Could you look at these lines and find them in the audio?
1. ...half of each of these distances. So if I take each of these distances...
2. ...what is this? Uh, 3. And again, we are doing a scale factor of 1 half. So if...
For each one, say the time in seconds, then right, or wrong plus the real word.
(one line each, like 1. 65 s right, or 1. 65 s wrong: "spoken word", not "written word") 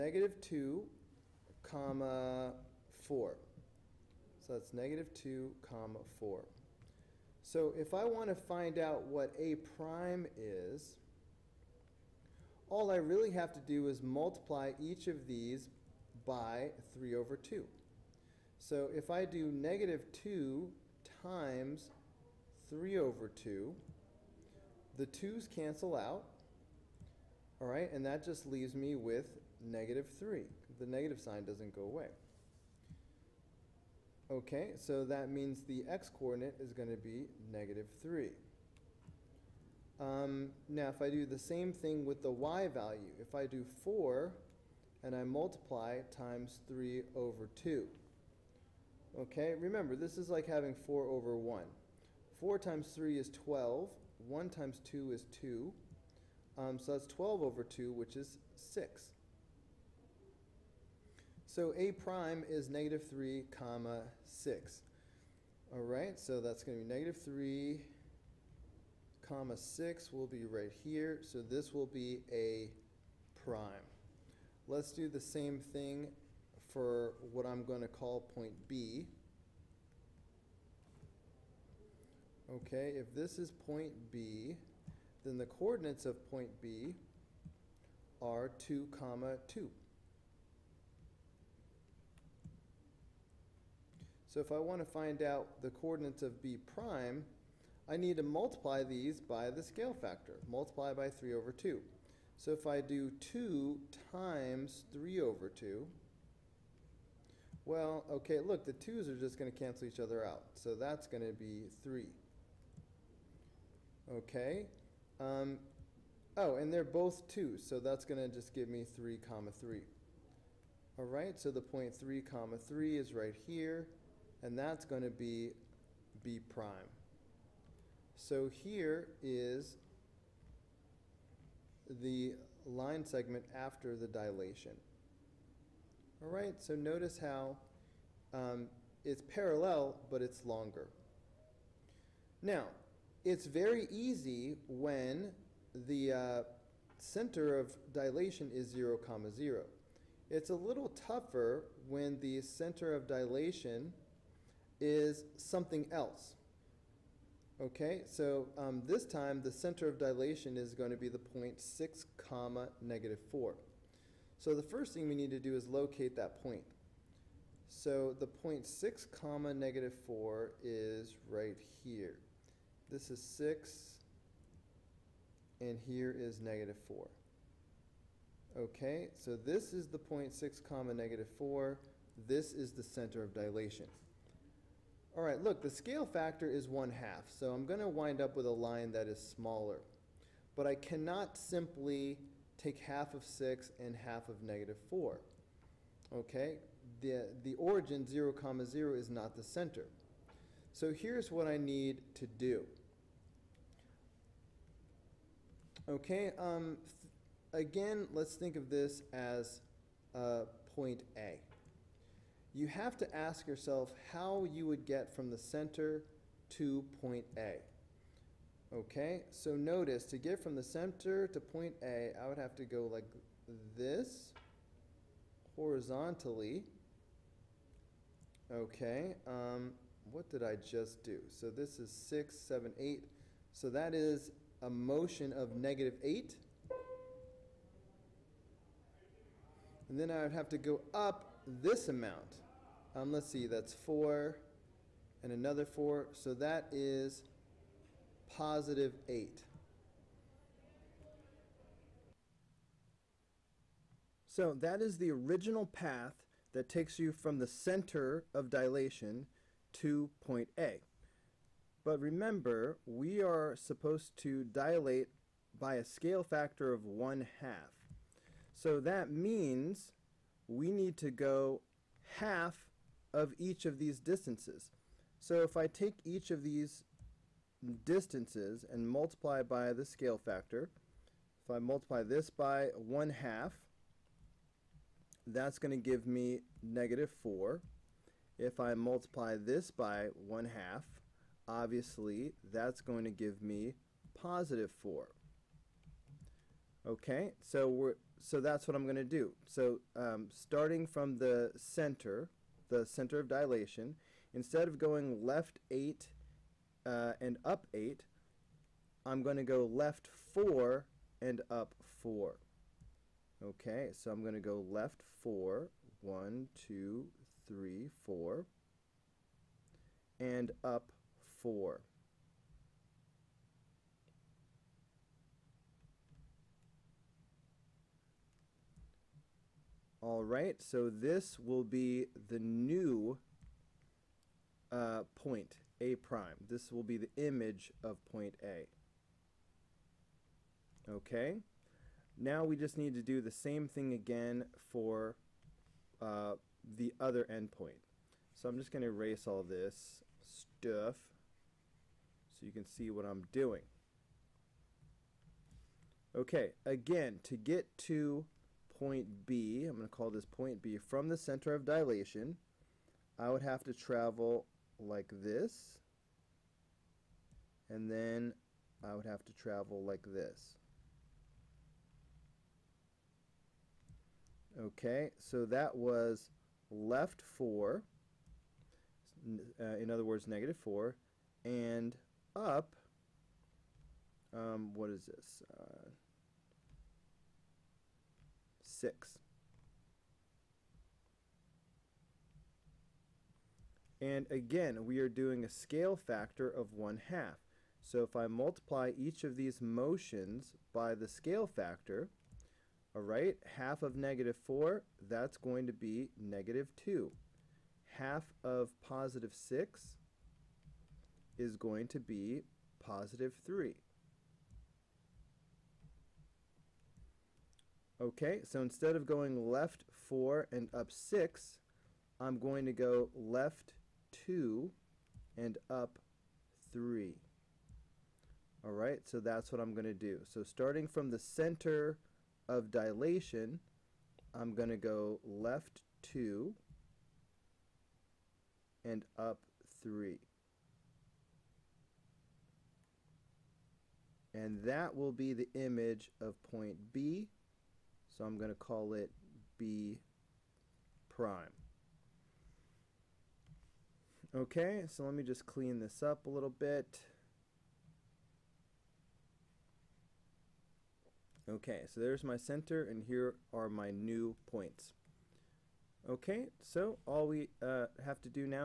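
1. 272 s right
2. 384 s wrong: "6", not "3".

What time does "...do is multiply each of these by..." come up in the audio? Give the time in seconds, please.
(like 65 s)
13 s.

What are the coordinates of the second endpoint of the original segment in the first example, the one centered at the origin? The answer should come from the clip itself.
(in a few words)
(2, 2).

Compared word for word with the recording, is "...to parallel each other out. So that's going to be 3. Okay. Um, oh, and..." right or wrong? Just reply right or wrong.
wrong.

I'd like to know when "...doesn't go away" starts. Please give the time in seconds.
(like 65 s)
31 s.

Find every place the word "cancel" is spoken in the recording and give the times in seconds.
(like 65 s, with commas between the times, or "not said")
25 s, 109 s.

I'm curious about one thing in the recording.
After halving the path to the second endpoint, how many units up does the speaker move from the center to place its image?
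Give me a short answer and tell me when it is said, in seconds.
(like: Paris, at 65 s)
3, at 412 s.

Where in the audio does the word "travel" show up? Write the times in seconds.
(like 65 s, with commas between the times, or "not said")
363 s, 369 s.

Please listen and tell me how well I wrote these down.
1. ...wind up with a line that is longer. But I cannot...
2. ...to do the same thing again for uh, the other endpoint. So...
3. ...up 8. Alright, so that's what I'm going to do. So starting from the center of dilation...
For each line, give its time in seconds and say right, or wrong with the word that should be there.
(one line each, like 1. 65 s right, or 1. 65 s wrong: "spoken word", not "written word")
1. 187 s wrong: "smaller", not "longer"
2. 342 s right
3. 425 s wrong: "3", not "8".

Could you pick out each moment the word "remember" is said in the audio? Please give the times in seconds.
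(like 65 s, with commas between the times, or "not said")
49 s, 261 s.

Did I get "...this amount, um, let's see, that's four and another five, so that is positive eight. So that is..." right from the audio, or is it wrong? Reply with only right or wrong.
wrong.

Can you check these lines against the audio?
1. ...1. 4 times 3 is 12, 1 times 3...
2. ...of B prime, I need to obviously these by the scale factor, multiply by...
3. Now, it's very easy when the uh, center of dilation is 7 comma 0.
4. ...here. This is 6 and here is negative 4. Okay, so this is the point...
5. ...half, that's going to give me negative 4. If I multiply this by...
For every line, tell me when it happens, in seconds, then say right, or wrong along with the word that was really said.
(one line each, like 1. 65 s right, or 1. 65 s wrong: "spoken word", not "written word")
1. 51 s wrong: "2", not "3"
2. 96 s wrong: "multiply", not "obviously"
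3. 142 s wrong: "0", not "7"
4. 171 s right
5. 283 s right.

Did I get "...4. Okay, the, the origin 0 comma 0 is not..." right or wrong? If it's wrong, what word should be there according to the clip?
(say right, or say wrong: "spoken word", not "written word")
right.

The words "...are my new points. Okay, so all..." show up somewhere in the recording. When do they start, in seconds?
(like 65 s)
463 s.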